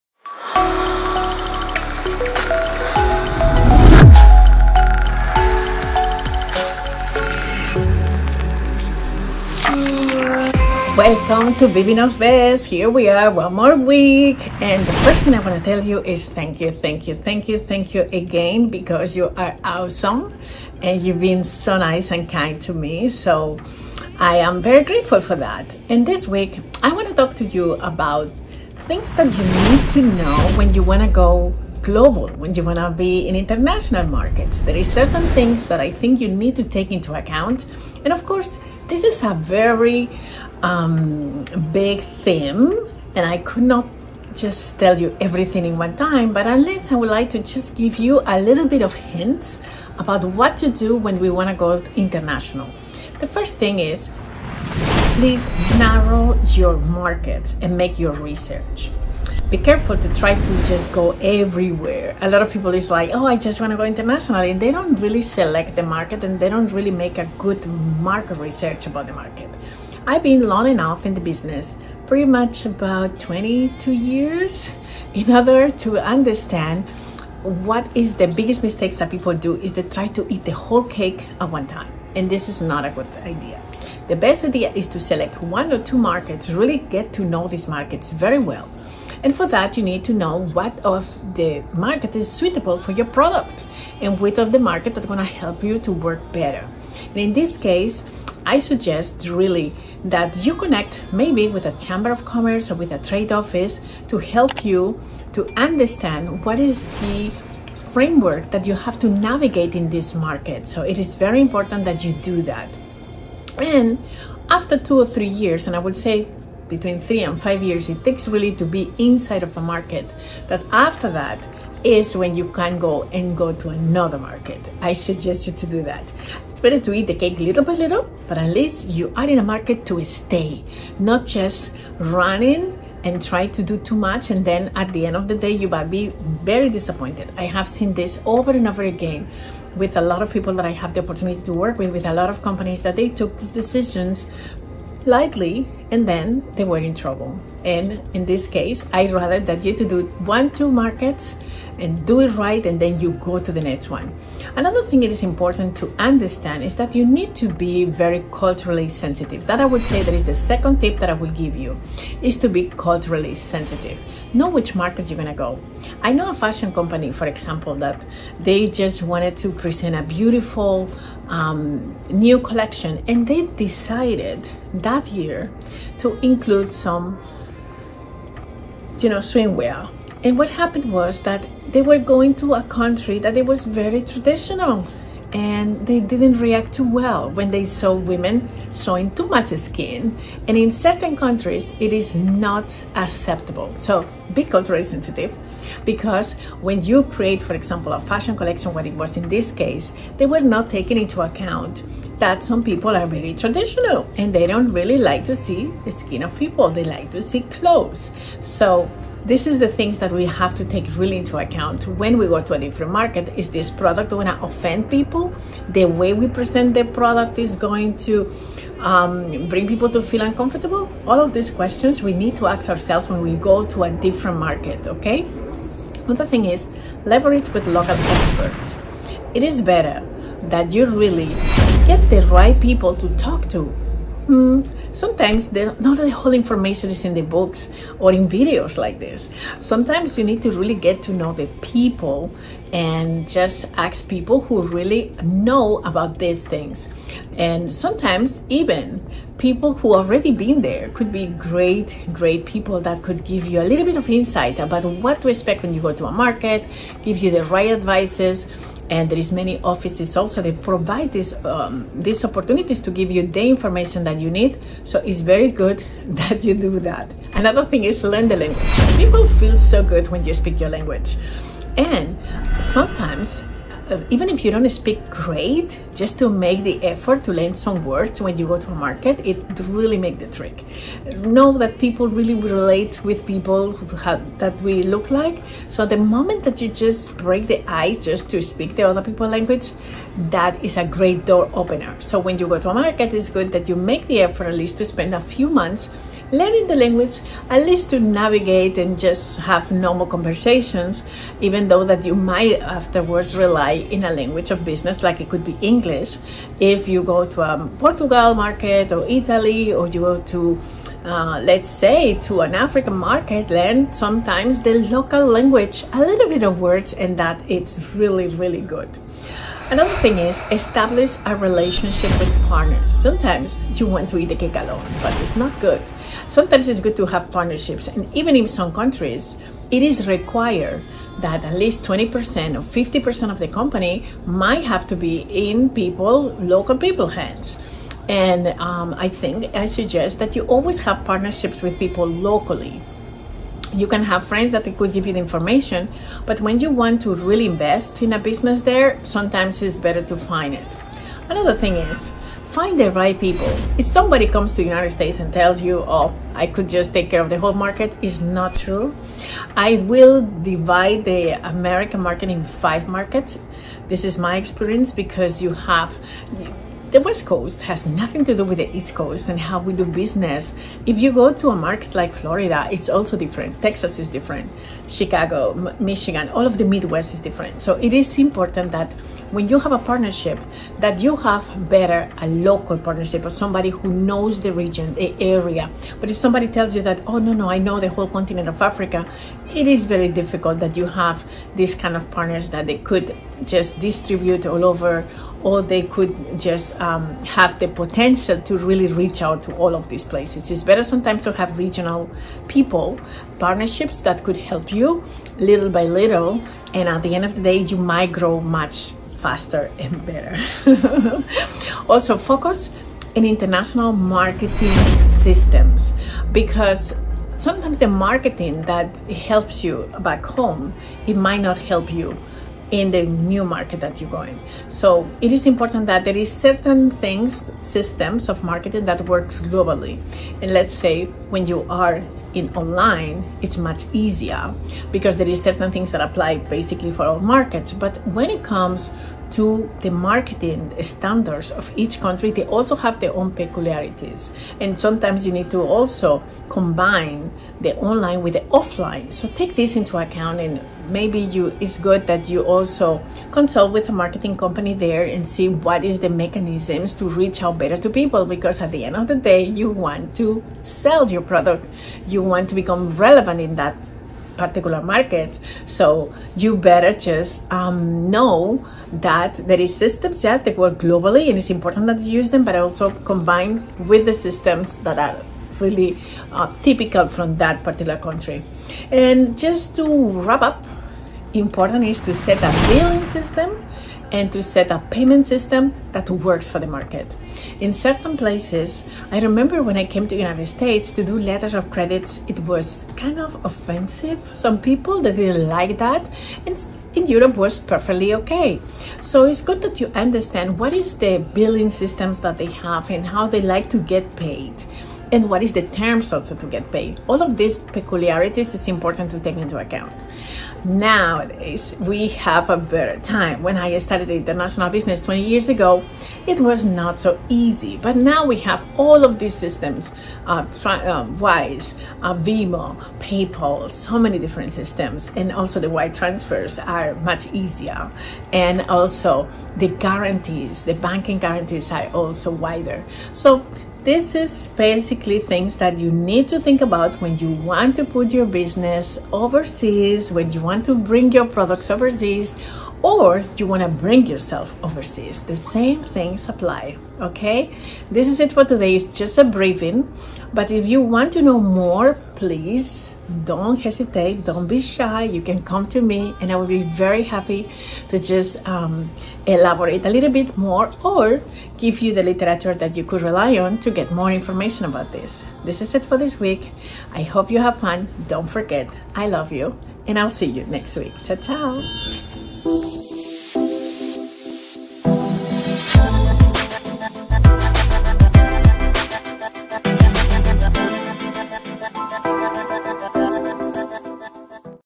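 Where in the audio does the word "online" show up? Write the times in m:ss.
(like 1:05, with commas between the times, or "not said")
7:12, 7:27.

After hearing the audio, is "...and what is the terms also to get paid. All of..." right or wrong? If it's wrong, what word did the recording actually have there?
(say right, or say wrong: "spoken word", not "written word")
right.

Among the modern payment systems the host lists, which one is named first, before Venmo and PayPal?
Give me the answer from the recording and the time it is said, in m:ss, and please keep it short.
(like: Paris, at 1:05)
Wise, at 8:41.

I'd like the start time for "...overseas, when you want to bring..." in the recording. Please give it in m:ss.
8:59.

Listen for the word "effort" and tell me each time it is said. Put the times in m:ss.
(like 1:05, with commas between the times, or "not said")
4:36, 4:54.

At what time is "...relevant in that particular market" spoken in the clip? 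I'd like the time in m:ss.
7:42.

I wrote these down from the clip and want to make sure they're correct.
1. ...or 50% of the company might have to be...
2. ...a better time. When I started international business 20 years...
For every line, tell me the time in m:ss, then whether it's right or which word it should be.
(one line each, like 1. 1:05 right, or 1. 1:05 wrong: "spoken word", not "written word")
1. 5:32 right
2. 8:32 right.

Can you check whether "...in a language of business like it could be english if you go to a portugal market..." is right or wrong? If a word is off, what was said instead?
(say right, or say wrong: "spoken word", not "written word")
right.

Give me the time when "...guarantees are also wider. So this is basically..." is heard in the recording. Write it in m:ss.
8:51.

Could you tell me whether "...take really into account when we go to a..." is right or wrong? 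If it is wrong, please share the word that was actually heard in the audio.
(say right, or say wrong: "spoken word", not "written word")
right.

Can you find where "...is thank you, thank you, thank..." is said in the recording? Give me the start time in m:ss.
0:16.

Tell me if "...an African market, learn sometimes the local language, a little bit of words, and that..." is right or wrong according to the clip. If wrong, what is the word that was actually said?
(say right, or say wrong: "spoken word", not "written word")
right.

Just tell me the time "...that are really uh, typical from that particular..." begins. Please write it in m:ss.
7:54.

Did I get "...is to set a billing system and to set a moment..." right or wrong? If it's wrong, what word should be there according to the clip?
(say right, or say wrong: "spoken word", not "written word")
wrong: "payment", not "moment".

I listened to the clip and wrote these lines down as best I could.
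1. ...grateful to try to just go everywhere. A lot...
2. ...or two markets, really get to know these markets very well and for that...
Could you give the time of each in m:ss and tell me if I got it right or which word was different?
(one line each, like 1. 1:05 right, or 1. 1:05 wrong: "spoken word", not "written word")
1. 0:59 wrong: "careful", not "grateful"
2. 1:25 right.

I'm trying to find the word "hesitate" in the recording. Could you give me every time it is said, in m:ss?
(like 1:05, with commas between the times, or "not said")
9:13.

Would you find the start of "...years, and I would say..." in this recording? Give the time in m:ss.
1:55.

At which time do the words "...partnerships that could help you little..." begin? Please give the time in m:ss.
6:43.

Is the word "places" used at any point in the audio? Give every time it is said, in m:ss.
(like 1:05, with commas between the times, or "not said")
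6:40, 8:08.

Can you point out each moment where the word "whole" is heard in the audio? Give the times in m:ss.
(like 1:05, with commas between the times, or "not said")
1:20, 3:56, 5:57, 6:27.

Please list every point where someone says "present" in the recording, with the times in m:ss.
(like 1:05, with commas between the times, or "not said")
2:49, 3:36.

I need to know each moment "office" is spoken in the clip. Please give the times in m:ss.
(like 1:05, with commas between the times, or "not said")
1:43, 4:19.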